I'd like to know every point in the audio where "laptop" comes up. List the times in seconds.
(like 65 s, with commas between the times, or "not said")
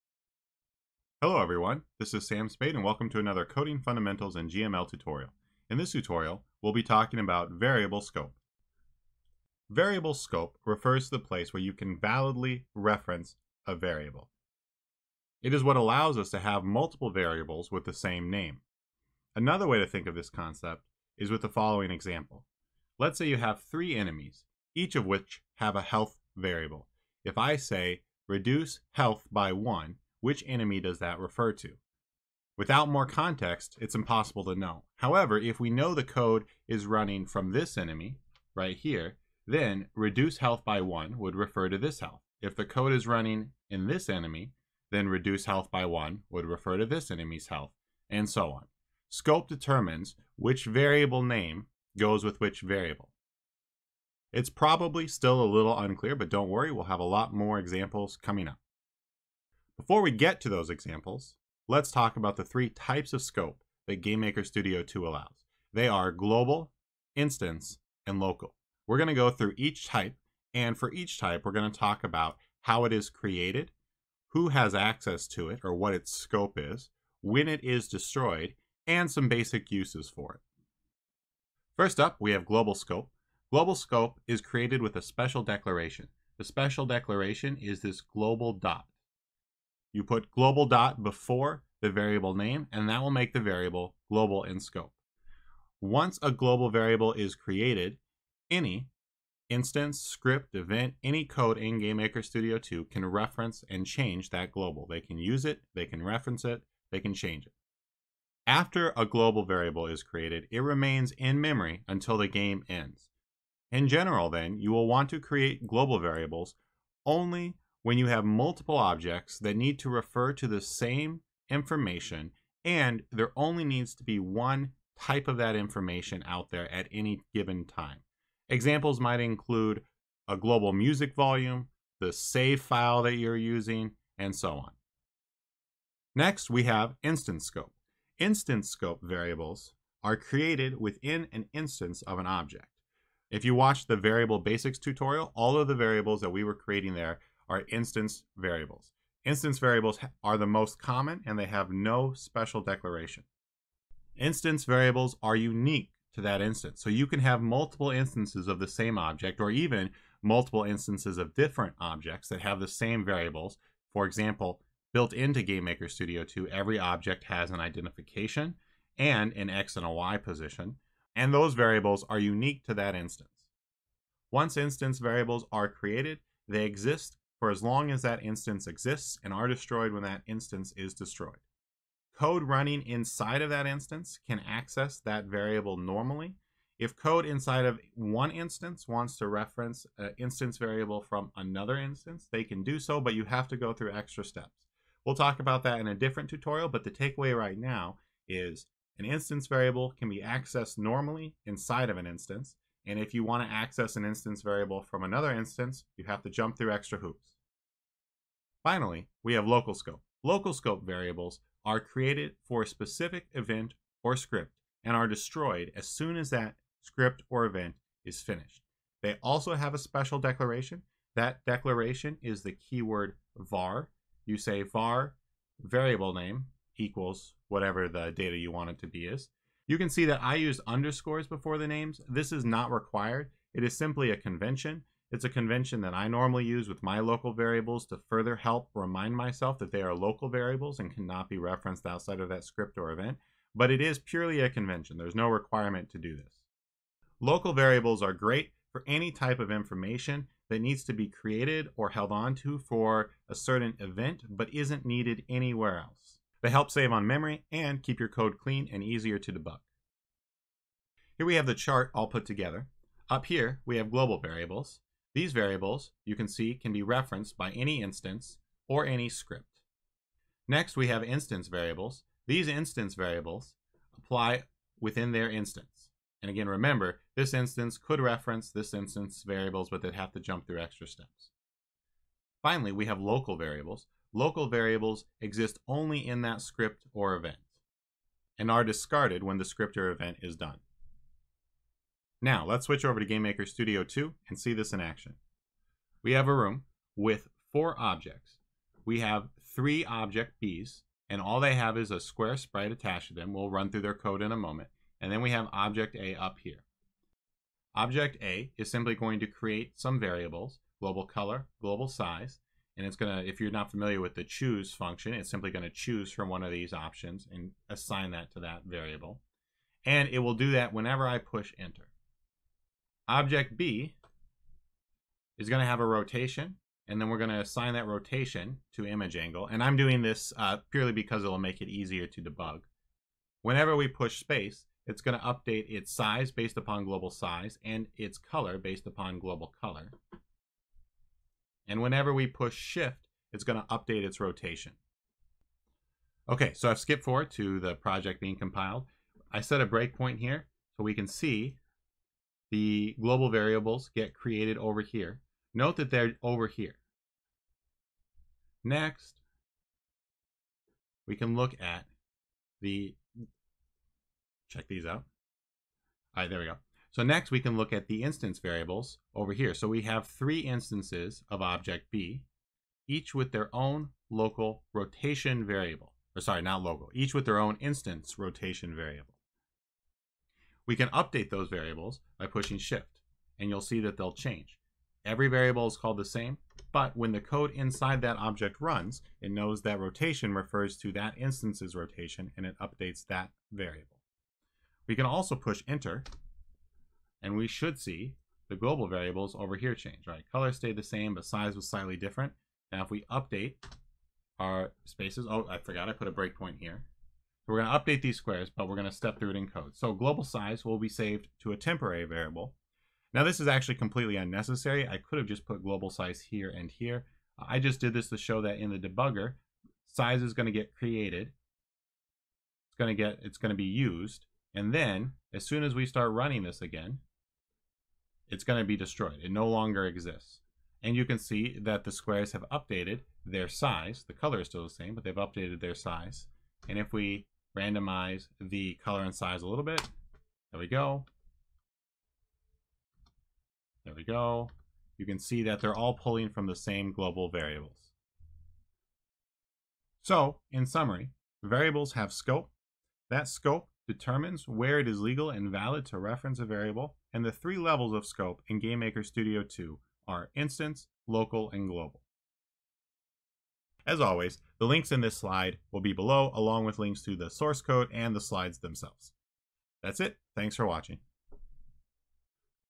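not said.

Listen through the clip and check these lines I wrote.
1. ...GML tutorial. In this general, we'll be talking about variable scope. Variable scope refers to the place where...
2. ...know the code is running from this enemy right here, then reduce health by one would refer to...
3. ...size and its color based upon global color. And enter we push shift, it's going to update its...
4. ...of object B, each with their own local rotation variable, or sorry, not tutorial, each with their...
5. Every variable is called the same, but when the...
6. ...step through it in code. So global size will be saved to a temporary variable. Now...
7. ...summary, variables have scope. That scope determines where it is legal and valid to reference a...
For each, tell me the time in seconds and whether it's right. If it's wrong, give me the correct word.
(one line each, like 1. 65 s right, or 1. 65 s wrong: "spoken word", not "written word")
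1. 4 s wrong: "tutorial", not "general"
2. 35 s right
3. 337 s wrong: "whenever", not "enter"
4. 371 s wrong: "local", not "tutorial"
5. 385 s right
6. 408 s right
7. 450 s right.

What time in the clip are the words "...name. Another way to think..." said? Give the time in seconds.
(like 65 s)
18 s.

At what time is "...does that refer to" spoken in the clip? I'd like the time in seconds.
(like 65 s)
30 s.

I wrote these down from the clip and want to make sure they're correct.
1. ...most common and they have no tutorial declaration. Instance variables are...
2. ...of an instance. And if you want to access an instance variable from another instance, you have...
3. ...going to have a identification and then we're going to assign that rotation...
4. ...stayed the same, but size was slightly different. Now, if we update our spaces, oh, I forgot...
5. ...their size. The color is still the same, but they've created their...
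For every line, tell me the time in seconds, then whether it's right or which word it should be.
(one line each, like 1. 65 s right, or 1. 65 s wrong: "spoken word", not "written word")
1. 150 s wrong: "special", not "tutorial"
2. 201 s right
3. 325 s wrong: "rotation", not "identification"
4. 400 s right
5. 433 s wrong: "updated", not "created".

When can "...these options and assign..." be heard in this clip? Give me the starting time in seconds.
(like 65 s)
316 s.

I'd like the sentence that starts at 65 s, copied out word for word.
They are global, instance, and local.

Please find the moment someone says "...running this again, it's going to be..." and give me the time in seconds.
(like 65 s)
426 s.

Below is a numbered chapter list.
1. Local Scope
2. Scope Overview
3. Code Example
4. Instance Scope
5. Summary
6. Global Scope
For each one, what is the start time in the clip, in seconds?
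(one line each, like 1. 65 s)
1. 208 s
2. 260 s
3. 294 s
4. 135 s
5. 449 s
6. 81 s.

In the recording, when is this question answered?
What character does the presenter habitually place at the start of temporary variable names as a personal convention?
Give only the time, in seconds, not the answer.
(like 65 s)
230 s.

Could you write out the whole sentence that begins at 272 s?
These instance variables apply within their instance.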